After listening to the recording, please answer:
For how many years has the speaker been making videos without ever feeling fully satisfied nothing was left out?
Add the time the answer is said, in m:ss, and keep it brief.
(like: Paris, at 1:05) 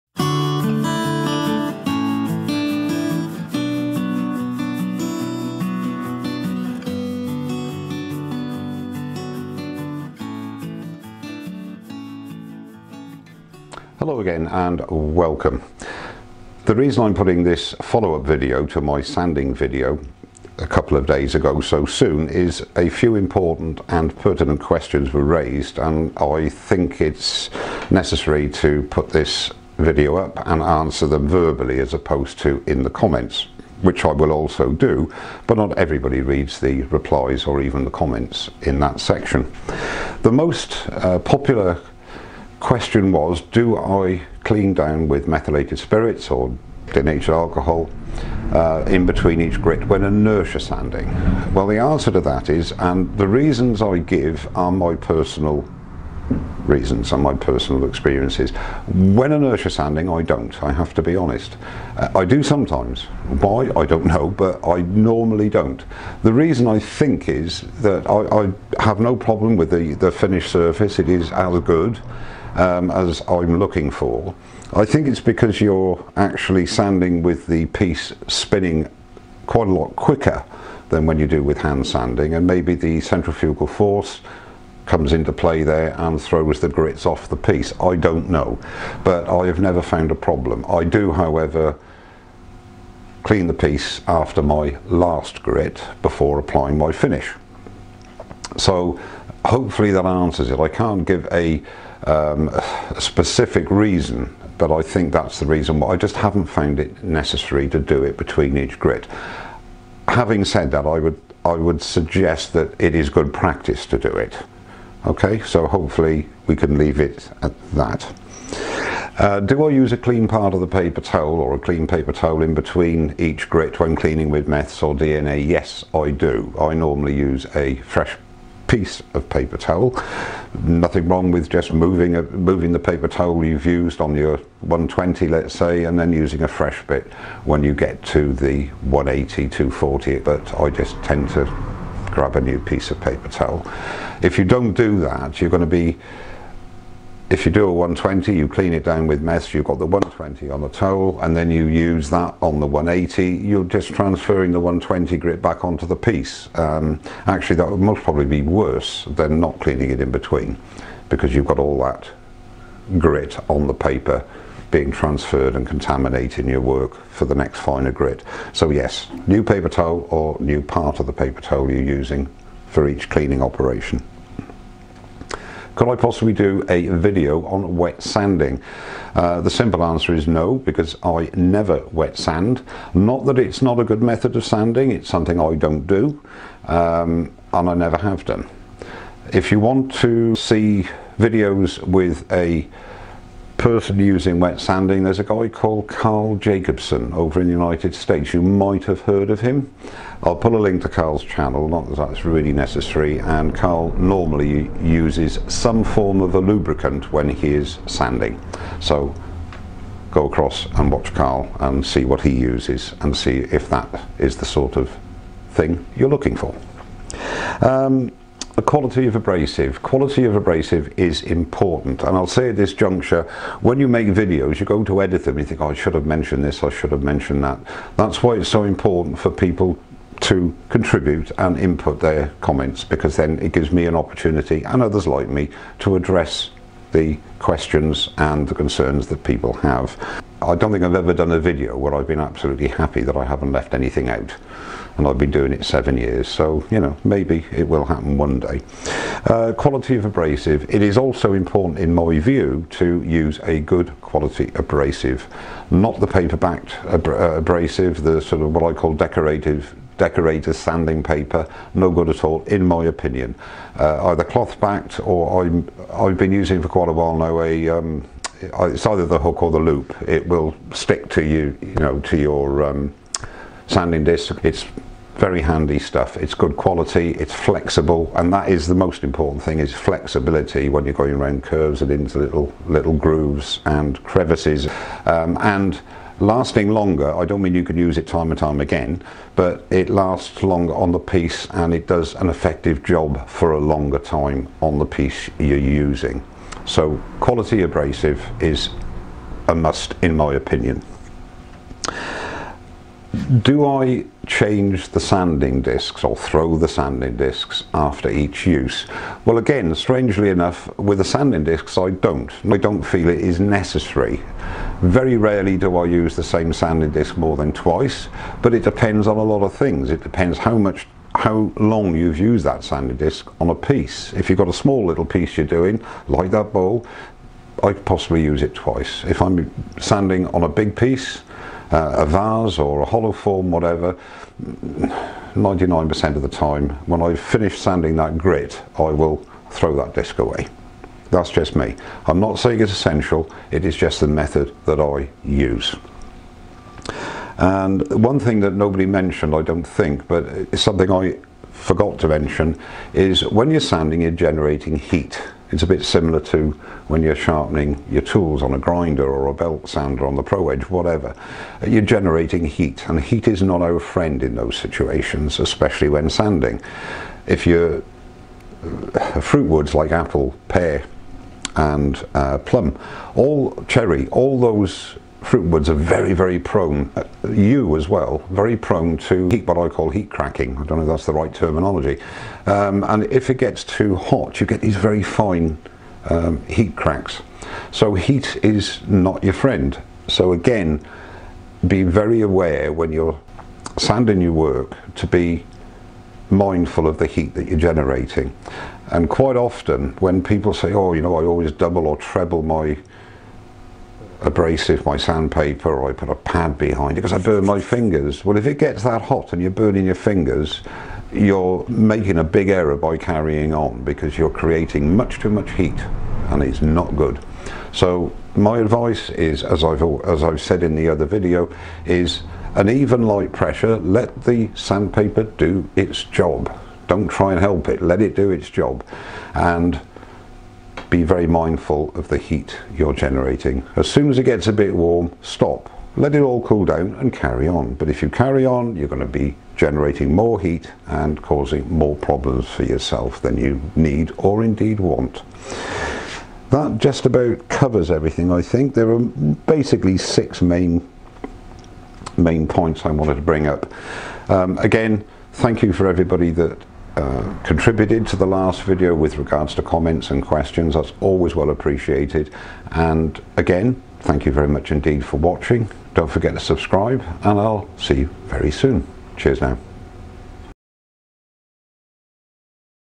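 7, at 4:05.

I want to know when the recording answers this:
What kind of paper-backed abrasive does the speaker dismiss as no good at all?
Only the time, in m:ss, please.
4:20.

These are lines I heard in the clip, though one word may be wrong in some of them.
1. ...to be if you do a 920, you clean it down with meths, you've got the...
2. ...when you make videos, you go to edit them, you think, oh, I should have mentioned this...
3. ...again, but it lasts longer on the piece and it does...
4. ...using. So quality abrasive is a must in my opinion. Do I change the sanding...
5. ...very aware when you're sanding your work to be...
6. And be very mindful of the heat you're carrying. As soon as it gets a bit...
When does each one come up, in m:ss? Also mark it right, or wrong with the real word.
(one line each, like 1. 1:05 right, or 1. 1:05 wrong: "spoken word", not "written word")
1. 2:25 wrong: "120", not "920"
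2. 3:43 right
3. 4:48 right
4. 4:55 right
5. 6:31 right
6. 7:09 wrong: "generating", not "carrying".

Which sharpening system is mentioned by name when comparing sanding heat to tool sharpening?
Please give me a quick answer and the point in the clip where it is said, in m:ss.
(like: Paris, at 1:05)
ProEdge, at 6:00.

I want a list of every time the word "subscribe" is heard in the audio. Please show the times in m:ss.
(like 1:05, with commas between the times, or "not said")
7:46.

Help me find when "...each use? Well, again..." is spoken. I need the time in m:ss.
5:08.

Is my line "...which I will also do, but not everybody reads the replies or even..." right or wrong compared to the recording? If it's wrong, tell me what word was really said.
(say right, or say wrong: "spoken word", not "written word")
right.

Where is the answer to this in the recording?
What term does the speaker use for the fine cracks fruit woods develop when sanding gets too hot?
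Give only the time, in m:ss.
6:19.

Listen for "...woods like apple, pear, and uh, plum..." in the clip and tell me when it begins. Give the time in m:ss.
6:09.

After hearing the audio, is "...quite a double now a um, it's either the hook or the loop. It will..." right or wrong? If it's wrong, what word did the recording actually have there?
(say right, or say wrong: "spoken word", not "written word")
wrong: "while", not "double".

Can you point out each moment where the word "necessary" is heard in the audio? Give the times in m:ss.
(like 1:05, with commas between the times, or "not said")
0:27, 1:47, 3:22, 5:13.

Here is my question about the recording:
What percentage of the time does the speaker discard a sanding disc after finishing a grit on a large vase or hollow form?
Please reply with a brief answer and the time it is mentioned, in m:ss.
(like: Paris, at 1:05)
99%, at 5:34.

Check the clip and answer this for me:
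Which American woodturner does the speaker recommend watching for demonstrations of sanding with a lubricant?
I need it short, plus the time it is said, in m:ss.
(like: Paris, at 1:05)
Carl Jacobson, at 3:15.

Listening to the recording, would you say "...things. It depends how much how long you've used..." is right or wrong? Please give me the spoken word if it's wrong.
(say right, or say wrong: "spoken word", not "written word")
right.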